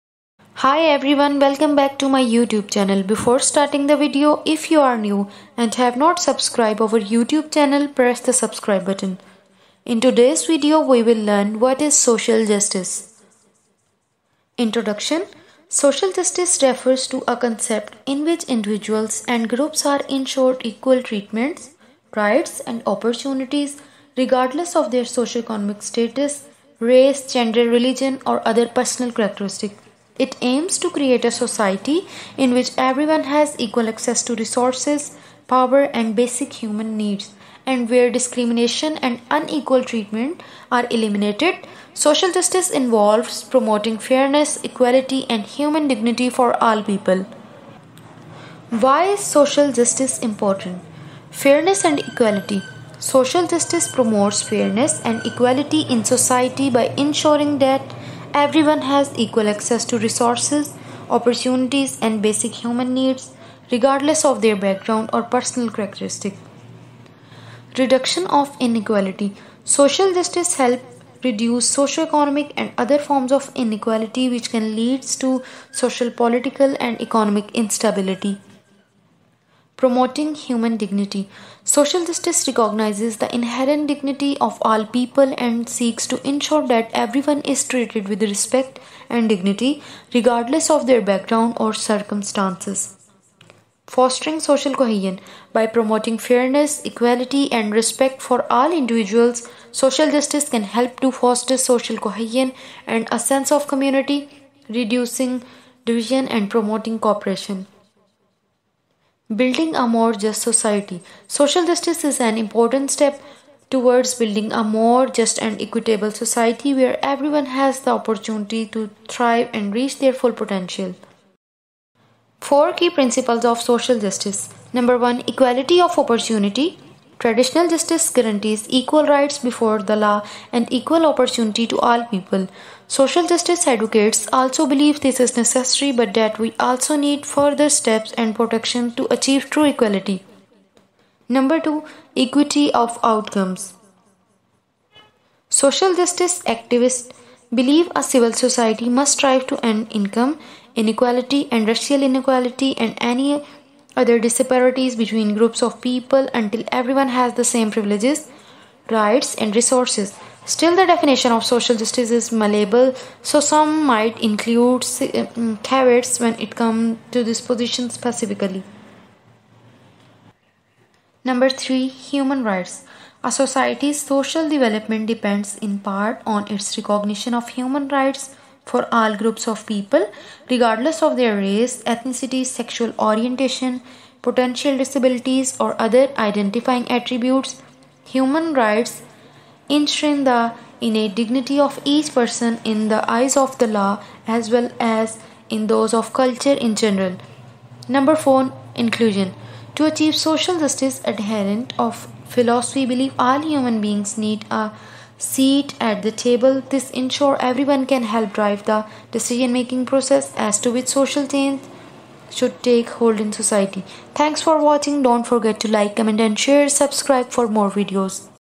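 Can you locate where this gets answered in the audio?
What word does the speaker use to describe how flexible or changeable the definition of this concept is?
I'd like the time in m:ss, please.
2:42.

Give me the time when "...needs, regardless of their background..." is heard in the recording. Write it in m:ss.
1:02.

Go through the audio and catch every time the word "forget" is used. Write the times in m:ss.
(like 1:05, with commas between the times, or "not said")
3:35.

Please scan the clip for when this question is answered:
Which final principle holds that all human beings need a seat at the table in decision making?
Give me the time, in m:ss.
3:18.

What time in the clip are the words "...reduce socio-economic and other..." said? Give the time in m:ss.
1:11.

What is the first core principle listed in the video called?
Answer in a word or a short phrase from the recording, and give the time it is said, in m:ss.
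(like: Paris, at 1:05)
Equality of opportunity, at 2:05.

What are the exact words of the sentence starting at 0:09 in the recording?
In today's video, we will learn what is social justice.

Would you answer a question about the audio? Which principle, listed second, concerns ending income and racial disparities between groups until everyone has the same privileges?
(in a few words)
Equity of Outcomes.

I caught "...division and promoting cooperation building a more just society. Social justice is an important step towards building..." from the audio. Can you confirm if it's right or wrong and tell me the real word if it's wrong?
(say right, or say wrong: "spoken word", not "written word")
right.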